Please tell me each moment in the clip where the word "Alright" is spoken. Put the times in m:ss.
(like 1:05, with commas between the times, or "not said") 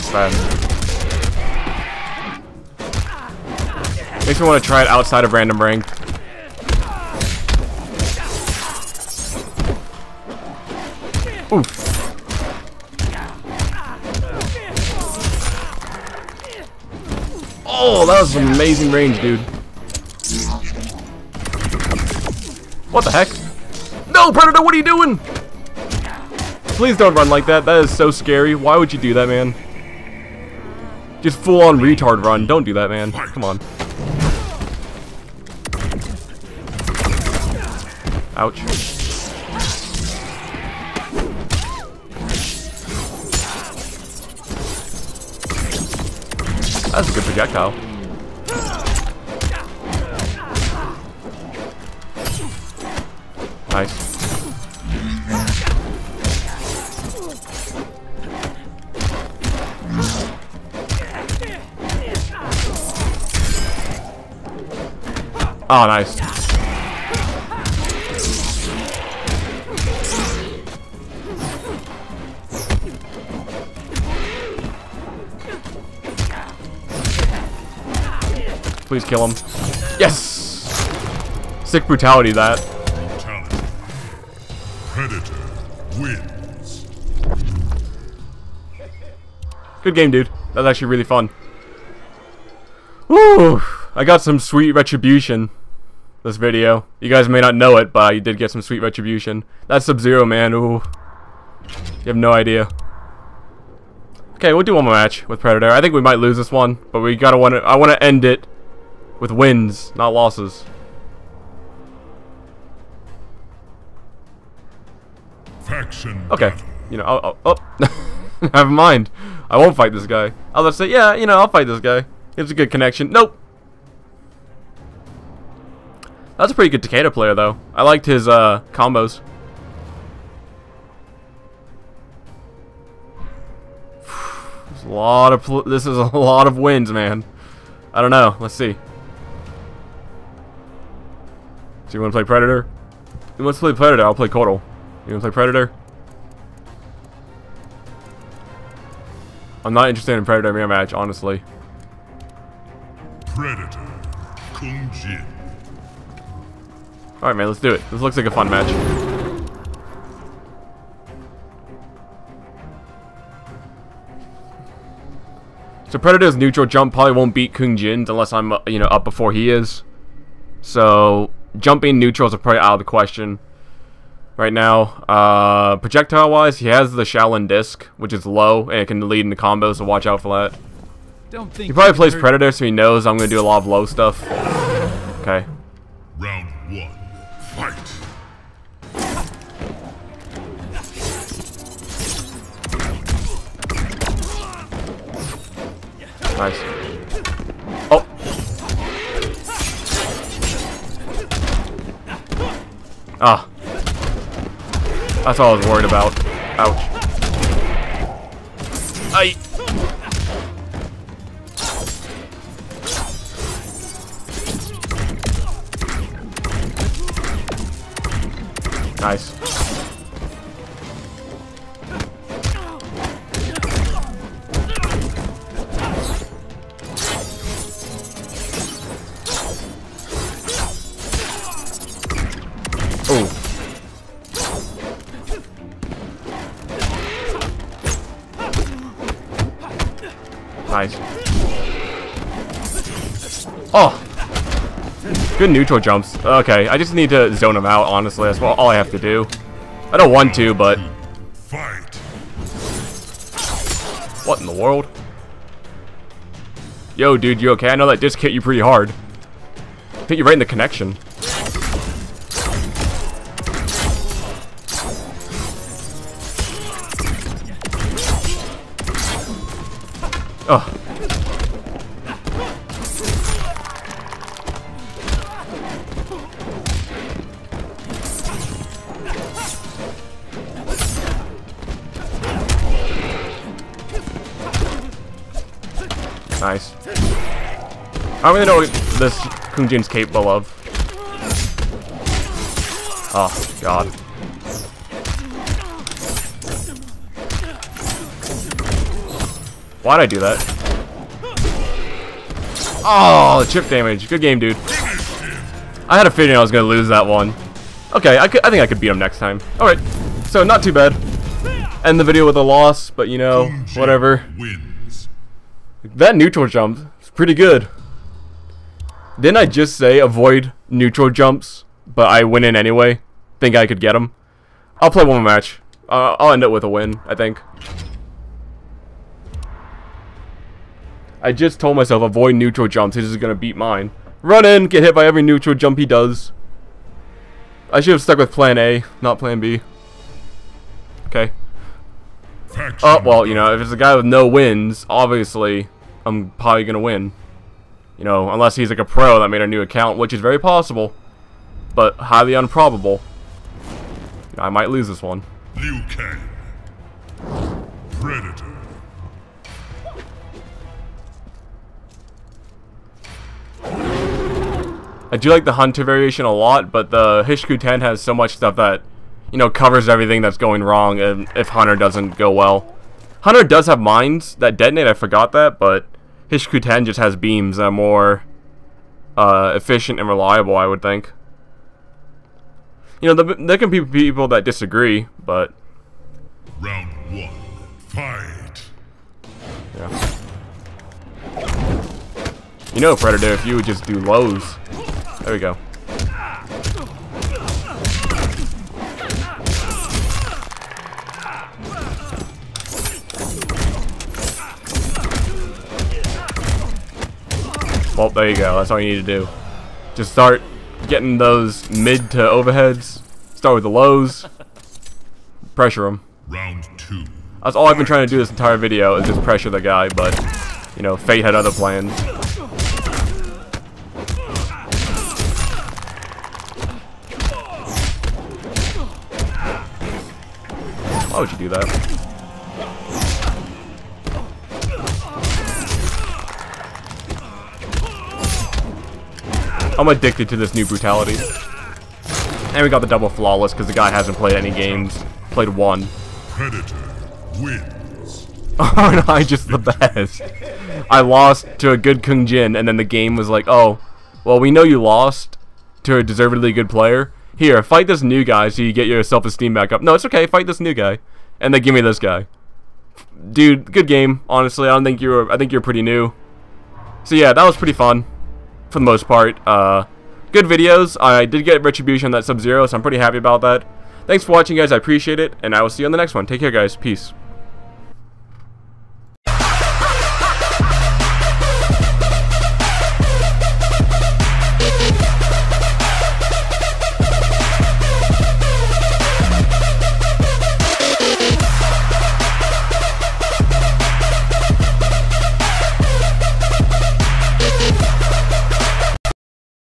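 2:37, 5:09.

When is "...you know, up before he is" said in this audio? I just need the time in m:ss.
2:48.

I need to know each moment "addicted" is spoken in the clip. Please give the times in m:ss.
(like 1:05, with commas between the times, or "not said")
7:19.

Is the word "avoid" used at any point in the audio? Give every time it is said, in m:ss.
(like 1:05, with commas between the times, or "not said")
5:19, 5:32.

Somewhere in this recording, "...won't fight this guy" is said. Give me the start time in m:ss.
1:59.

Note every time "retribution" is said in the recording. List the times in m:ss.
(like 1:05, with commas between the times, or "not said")
1:34, 1:38, 7:51.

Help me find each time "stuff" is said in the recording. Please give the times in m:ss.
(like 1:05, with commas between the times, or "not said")
3:03, 6:08.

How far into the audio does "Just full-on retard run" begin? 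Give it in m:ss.
0:31.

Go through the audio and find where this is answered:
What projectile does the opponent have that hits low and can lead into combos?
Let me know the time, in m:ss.
2:57.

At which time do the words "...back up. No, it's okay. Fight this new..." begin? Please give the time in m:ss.
7:39.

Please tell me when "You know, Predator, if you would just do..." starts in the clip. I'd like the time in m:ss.
6:32.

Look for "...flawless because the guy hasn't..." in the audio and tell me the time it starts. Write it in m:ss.
7:23.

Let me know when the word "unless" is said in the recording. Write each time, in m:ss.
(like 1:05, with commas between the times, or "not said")
2:48, 5:48.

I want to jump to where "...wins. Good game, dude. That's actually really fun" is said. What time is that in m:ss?
1:25.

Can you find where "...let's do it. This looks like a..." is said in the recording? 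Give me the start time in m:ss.
2:37.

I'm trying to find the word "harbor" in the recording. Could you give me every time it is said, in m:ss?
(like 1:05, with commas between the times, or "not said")
not said.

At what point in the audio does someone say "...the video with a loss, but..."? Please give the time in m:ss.
5:11.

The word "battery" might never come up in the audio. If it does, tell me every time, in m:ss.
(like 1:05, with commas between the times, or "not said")
not said.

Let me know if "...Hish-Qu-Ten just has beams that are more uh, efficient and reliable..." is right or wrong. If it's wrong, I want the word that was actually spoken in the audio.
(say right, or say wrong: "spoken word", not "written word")
right.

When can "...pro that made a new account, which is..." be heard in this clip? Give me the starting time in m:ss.
5:48.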